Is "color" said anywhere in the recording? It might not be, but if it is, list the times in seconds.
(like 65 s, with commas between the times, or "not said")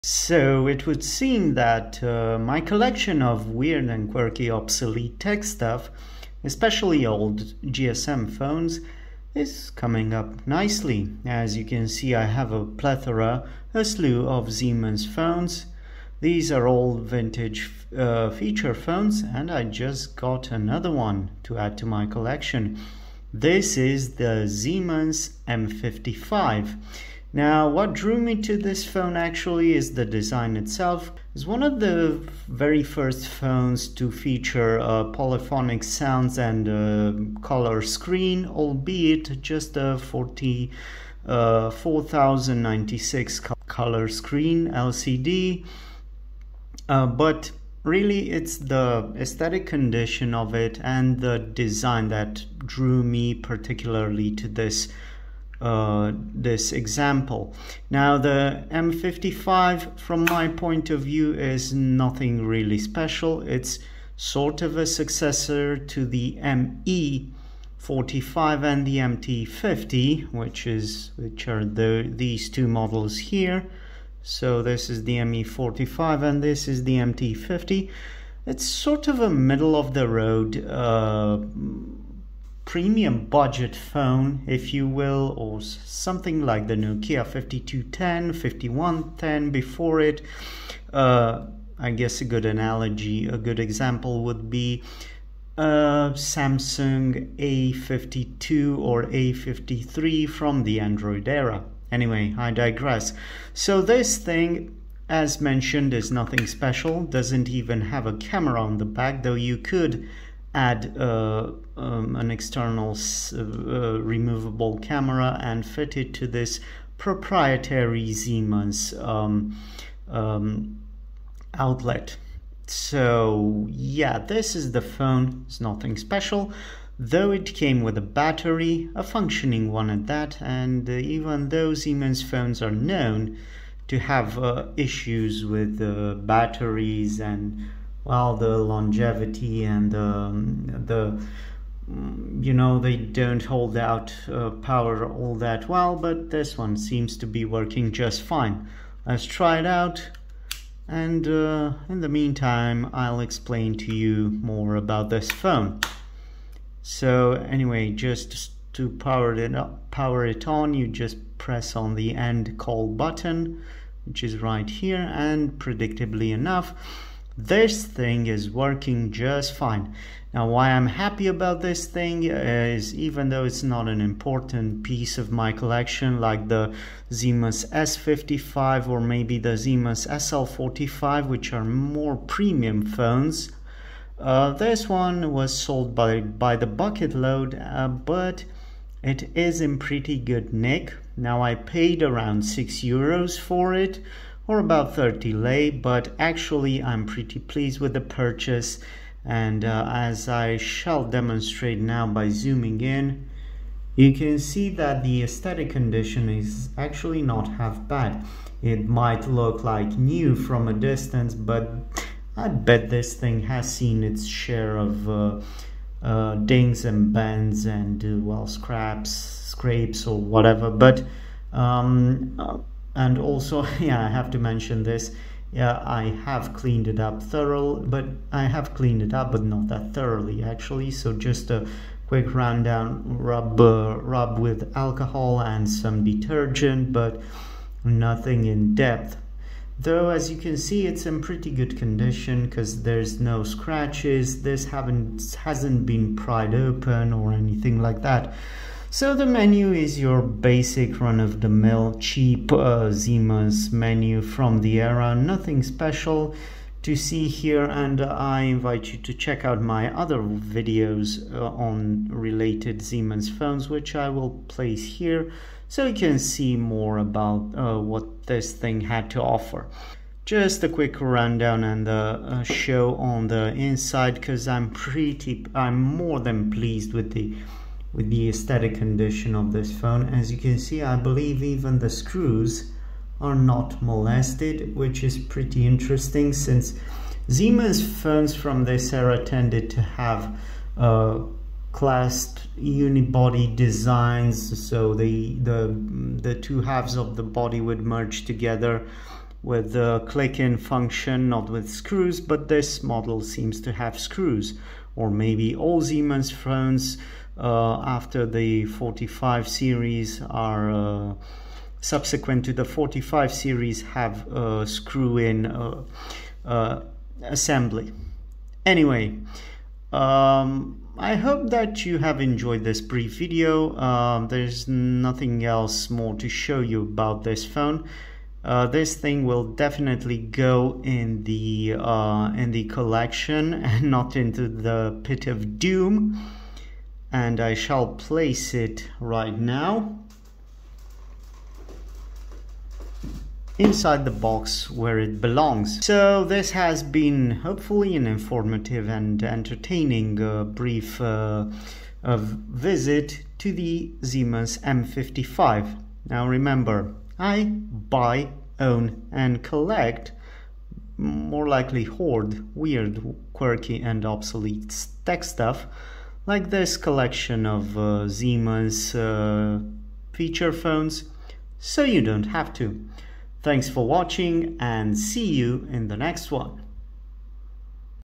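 37 s, 43 s.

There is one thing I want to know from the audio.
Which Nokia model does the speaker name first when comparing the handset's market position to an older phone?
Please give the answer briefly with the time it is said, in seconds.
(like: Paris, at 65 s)
Nokia 5210, at 86 s.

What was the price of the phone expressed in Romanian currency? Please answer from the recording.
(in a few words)
30 lei.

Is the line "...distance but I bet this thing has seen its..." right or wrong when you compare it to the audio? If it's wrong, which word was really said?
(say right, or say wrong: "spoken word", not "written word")
right.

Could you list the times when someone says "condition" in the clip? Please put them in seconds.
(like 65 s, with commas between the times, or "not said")
49 s, 205 s, 241 s, 278 s.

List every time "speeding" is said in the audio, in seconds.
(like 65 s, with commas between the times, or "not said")
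not said.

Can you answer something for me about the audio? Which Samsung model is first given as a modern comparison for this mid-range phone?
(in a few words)
Samsung A52.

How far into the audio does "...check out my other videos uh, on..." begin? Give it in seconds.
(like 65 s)
259 s.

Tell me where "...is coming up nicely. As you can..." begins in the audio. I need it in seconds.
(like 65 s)
9 s.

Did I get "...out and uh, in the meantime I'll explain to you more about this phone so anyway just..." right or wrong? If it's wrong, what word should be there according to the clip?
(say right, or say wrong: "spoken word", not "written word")
right.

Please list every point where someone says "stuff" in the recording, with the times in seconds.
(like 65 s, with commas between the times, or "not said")
5 s, 365 s.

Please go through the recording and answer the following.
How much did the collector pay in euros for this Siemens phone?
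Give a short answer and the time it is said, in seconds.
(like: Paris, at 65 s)
6 euros, at 192 s.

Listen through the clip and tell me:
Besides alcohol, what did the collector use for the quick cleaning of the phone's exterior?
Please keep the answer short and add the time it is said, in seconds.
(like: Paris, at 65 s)
detergent, at 236 s.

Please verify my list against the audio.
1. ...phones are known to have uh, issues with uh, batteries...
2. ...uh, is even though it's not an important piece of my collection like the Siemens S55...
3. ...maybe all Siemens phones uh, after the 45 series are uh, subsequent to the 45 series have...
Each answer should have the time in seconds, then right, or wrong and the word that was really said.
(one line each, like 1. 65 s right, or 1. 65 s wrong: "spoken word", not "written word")
1. 132 s right
2. 172 s right
3. 305 s right.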